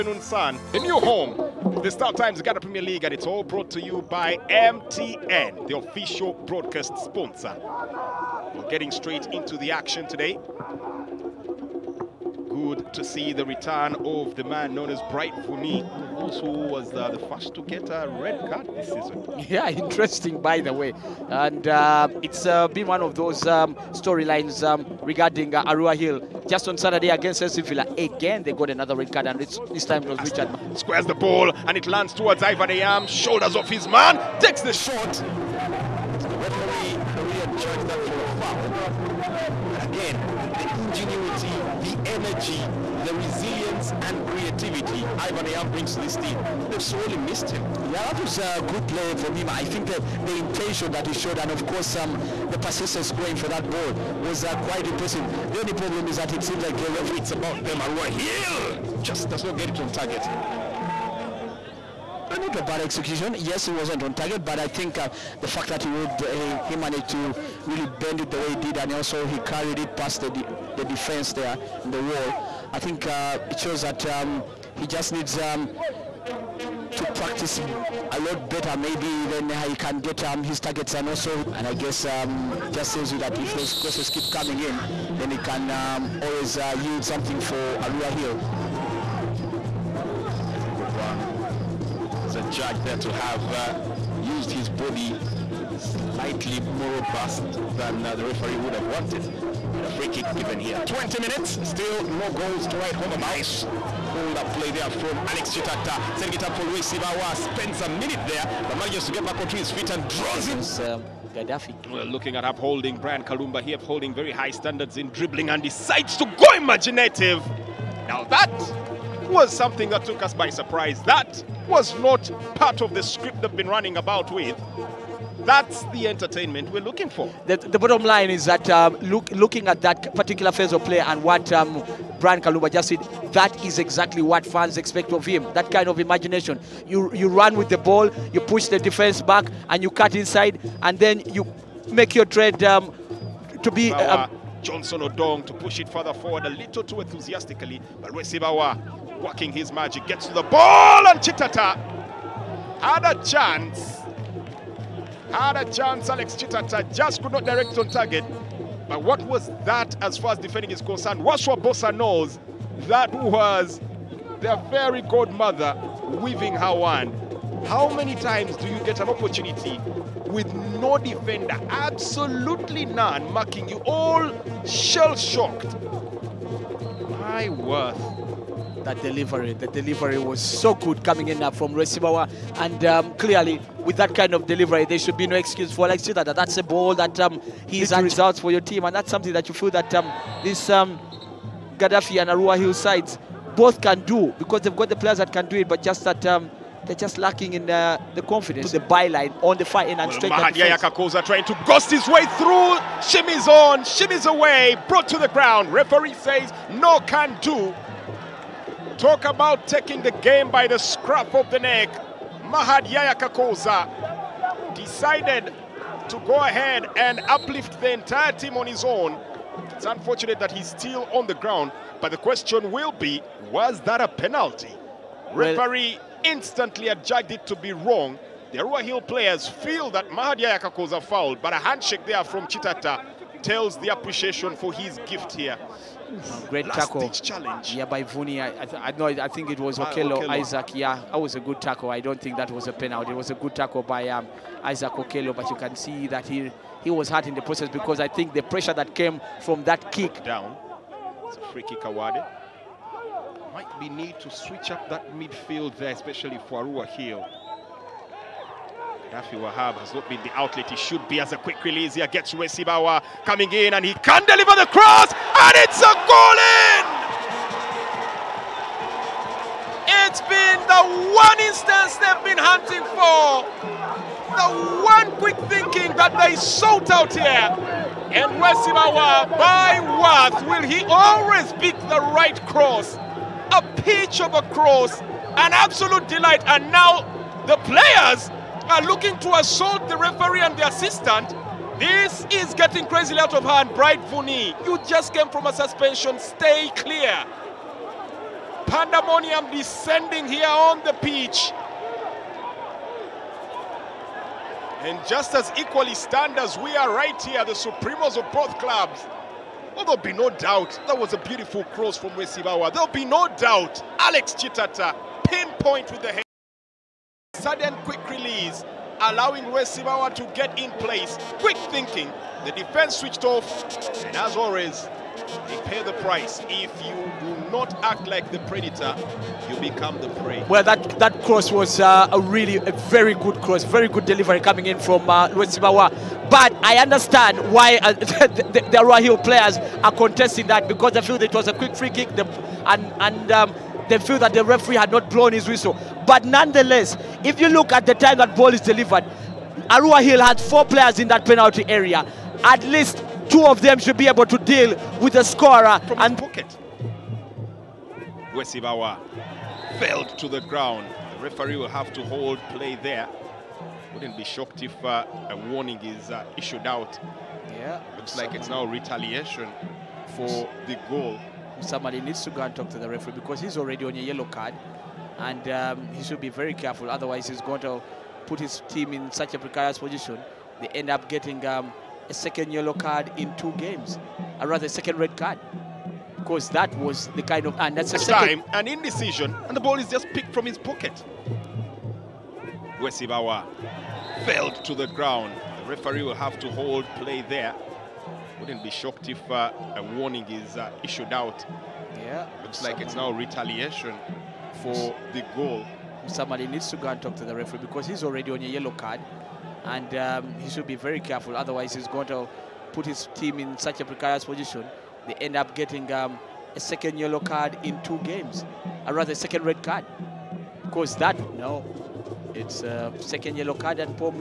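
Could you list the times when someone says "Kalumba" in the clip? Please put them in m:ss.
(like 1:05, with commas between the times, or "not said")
1:53, 2:12.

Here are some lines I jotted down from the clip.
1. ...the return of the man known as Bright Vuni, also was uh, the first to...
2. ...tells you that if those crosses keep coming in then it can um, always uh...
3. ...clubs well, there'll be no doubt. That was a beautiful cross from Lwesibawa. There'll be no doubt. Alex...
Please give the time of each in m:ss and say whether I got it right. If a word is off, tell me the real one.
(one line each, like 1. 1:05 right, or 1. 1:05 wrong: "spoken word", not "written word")
1. 0:13 right
2. 1:22 right
3. 5:08 right.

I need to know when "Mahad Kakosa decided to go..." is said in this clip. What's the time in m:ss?
3:32.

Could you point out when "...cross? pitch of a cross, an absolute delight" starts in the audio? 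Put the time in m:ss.
4:42.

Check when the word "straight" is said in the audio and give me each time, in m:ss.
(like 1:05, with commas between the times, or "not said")
0:08, 3:20.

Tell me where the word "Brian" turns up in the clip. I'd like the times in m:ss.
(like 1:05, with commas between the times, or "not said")
1:52, 2:12.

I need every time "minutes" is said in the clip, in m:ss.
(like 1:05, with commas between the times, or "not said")
1:41, 1:47.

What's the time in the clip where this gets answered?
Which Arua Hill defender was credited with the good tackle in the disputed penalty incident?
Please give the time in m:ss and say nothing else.
4:00.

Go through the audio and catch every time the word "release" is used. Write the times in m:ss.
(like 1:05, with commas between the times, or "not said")
4:21, 5:18.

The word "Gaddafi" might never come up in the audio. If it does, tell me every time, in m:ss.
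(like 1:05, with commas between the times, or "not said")
1:51, 3:11.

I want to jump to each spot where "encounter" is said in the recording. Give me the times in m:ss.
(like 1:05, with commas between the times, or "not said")
not said.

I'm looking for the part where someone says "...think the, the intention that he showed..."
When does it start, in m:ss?
0:49.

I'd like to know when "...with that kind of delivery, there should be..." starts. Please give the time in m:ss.
3:03.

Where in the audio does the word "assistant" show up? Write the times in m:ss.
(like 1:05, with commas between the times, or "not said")
4:50.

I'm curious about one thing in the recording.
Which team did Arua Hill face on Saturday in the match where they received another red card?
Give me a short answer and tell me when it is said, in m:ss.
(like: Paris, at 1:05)
SC Villa, at 0:27.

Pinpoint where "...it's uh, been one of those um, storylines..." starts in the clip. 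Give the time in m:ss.
0:22.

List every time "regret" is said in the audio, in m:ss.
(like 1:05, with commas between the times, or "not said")
not said.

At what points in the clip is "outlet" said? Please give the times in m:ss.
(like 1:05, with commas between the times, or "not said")
4:20.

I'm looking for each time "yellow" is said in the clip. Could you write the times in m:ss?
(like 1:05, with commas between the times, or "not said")
6:13, 6:22, 6:48, 6:56, 7:03.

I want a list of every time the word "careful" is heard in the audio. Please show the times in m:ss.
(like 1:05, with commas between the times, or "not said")
6:16, 6:50.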